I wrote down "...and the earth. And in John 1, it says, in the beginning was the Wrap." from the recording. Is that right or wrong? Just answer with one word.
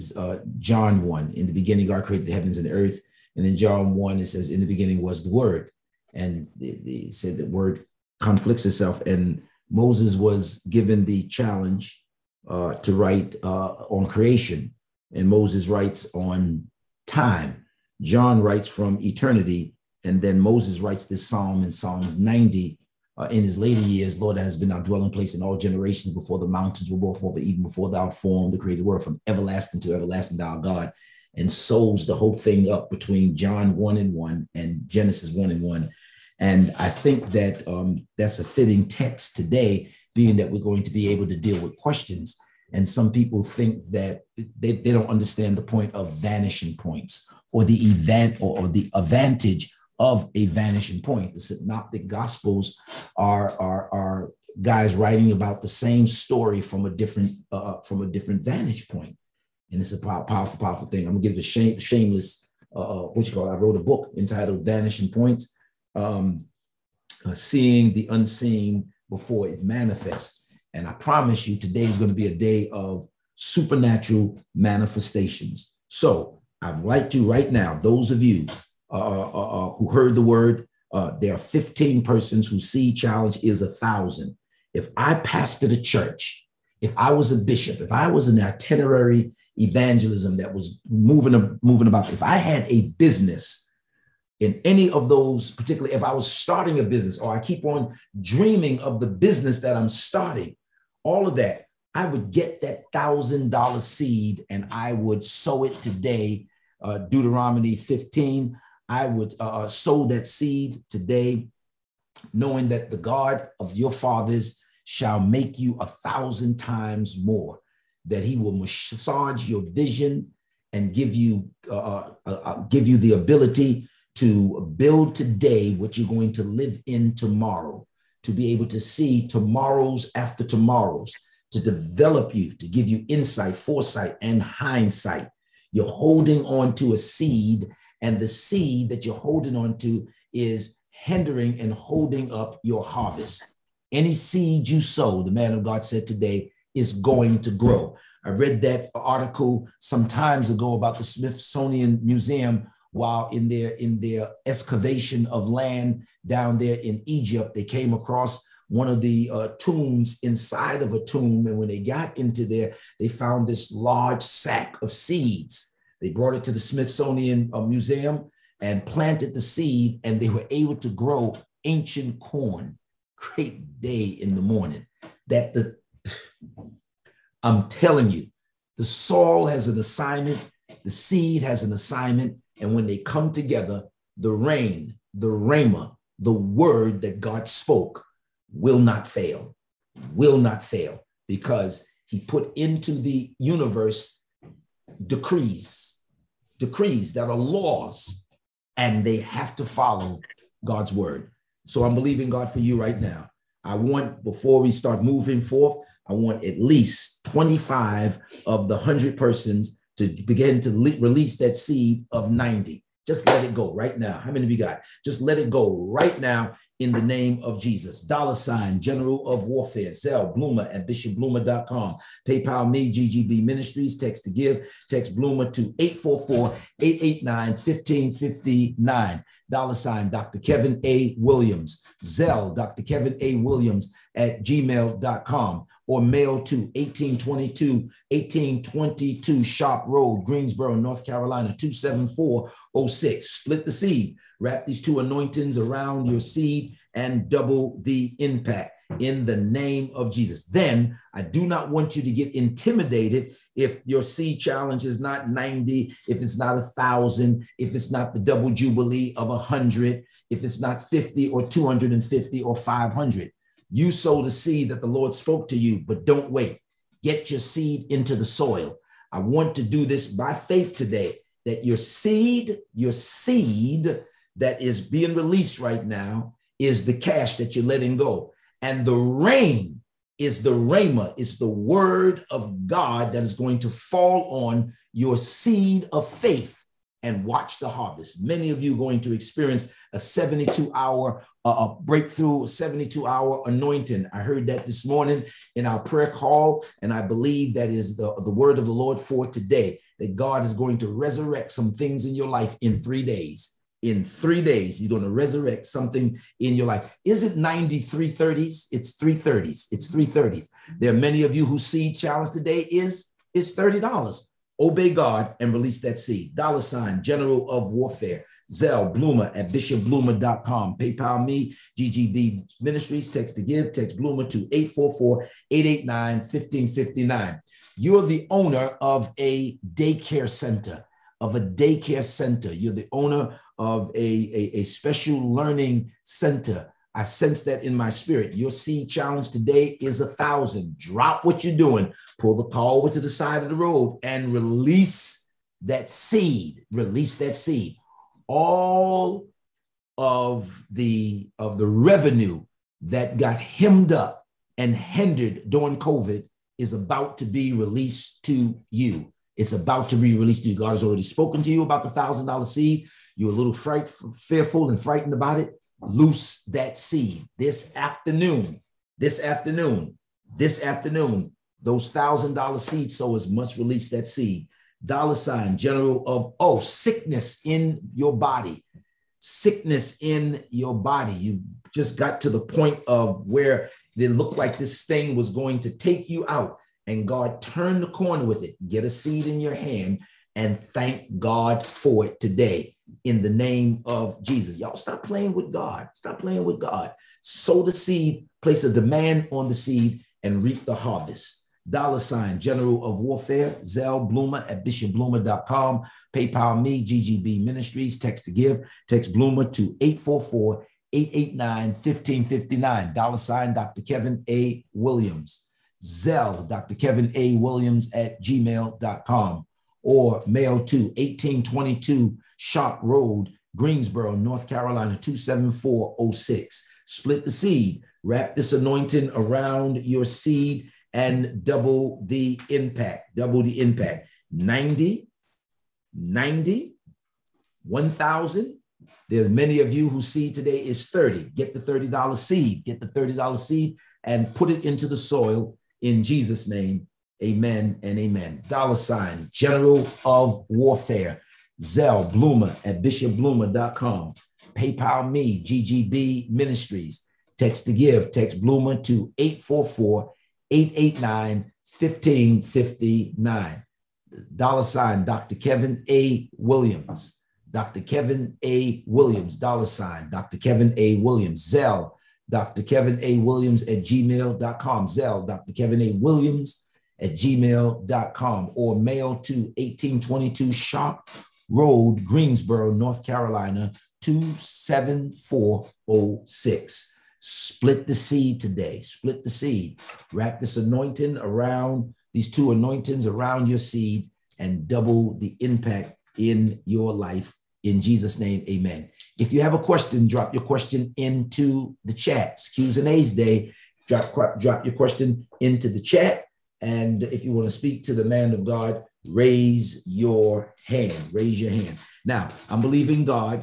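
wrong.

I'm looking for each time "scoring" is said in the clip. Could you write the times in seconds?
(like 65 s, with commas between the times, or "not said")
not said.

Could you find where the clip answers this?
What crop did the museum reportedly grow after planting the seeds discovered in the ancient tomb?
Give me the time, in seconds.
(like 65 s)
171 s.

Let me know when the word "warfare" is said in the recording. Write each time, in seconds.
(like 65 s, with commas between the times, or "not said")
219 s, 317 s, 403 s, 450 s.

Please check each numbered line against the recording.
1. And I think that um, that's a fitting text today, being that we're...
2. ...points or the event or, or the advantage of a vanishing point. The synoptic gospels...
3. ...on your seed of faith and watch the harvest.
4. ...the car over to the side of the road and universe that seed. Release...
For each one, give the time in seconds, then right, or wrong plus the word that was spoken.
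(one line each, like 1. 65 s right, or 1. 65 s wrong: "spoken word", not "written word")
1. 36 s right
2. 46 s right
3. 284 s right
4. 342 s wrong: "release", not "universe".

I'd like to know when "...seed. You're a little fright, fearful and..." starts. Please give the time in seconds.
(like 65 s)
362 s.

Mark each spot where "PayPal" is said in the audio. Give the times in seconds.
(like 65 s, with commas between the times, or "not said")
222 s, 320 s, 406 s, 454 s.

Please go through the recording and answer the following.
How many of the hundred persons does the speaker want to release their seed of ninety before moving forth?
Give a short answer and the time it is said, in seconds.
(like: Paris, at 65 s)
25, at 207 s.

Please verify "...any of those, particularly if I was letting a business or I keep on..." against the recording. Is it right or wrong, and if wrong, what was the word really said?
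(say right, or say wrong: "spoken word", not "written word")
wrong: "starting", not "letting".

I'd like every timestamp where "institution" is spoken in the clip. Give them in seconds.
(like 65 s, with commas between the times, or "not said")
not said.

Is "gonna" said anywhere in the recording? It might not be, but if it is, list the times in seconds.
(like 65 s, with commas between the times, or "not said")
61 s, 71 s.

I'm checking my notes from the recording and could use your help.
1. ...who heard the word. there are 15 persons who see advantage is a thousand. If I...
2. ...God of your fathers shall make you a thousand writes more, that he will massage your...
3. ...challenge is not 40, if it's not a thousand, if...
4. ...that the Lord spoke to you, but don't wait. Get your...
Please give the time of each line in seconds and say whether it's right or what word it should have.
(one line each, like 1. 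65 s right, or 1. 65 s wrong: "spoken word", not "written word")
1. 79 s wrong: "challenge", not "advantage"
2. 112 s wrong: "times", not "writes"
3. 254 s wrong: "90", not "40"
4. 264 s right.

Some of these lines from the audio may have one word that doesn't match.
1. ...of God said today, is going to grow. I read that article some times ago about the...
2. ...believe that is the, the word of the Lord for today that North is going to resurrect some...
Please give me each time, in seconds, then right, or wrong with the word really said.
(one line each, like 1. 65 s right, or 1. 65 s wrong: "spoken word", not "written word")
1. 145 s right
2. 297 s wrong: "God", not "North".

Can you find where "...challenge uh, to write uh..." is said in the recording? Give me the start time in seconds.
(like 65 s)
11 s.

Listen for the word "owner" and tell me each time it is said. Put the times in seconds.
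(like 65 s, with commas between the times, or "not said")
328 s, 332 s.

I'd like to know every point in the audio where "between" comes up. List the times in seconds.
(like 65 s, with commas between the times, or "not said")
32 s.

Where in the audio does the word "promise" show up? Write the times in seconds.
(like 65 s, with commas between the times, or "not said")
70 s.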